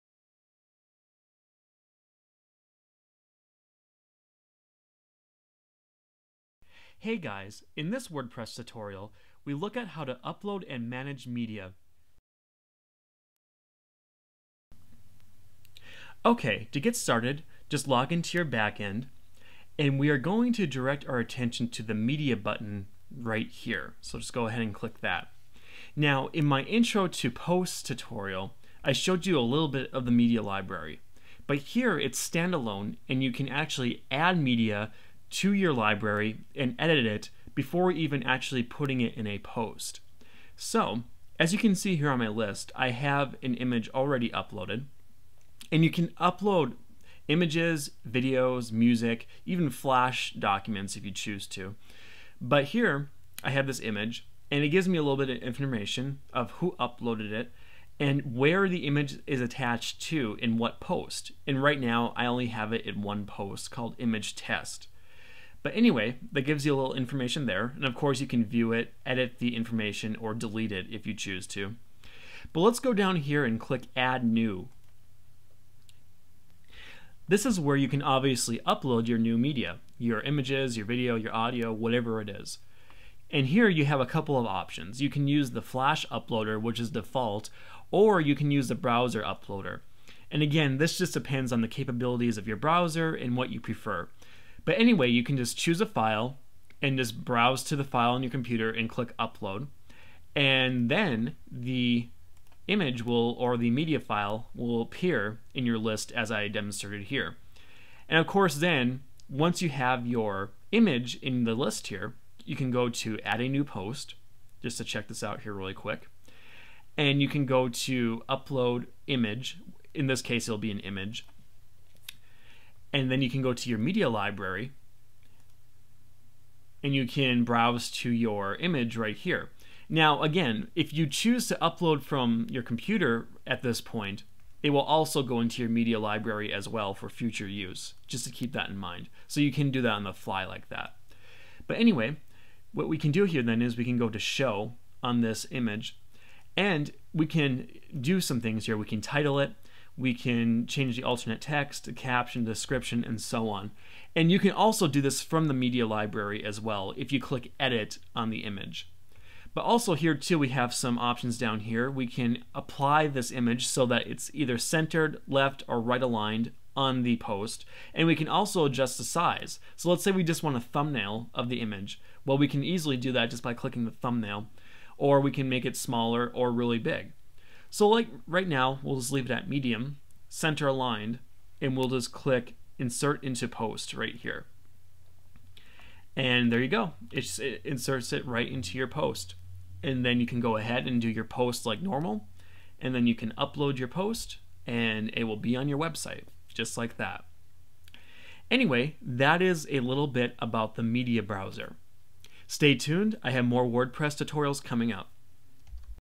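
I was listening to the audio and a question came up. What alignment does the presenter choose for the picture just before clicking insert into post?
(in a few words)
center aligned.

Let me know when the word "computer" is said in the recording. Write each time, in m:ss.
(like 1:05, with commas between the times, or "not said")
1:38, 2:12.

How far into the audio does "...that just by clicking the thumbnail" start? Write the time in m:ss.
2:53.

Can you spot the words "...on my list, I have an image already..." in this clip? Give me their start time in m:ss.
0:42.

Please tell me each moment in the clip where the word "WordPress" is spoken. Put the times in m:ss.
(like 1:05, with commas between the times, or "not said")
0:08, 3:23.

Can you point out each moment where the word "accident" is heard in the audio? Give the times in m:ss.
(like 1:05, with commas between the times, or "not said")
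not said.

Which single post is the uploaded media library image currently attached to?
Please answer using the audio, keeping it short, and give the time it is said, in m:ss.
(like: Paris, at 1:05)
image test, at 1:03.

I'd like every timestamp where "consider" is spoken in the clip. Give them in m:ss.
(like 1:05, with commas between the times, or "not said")
not said.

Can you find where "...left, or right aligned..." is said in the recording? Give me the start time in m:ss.
2:45.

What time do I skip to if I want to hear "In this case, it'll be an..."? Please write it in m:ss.
1:59.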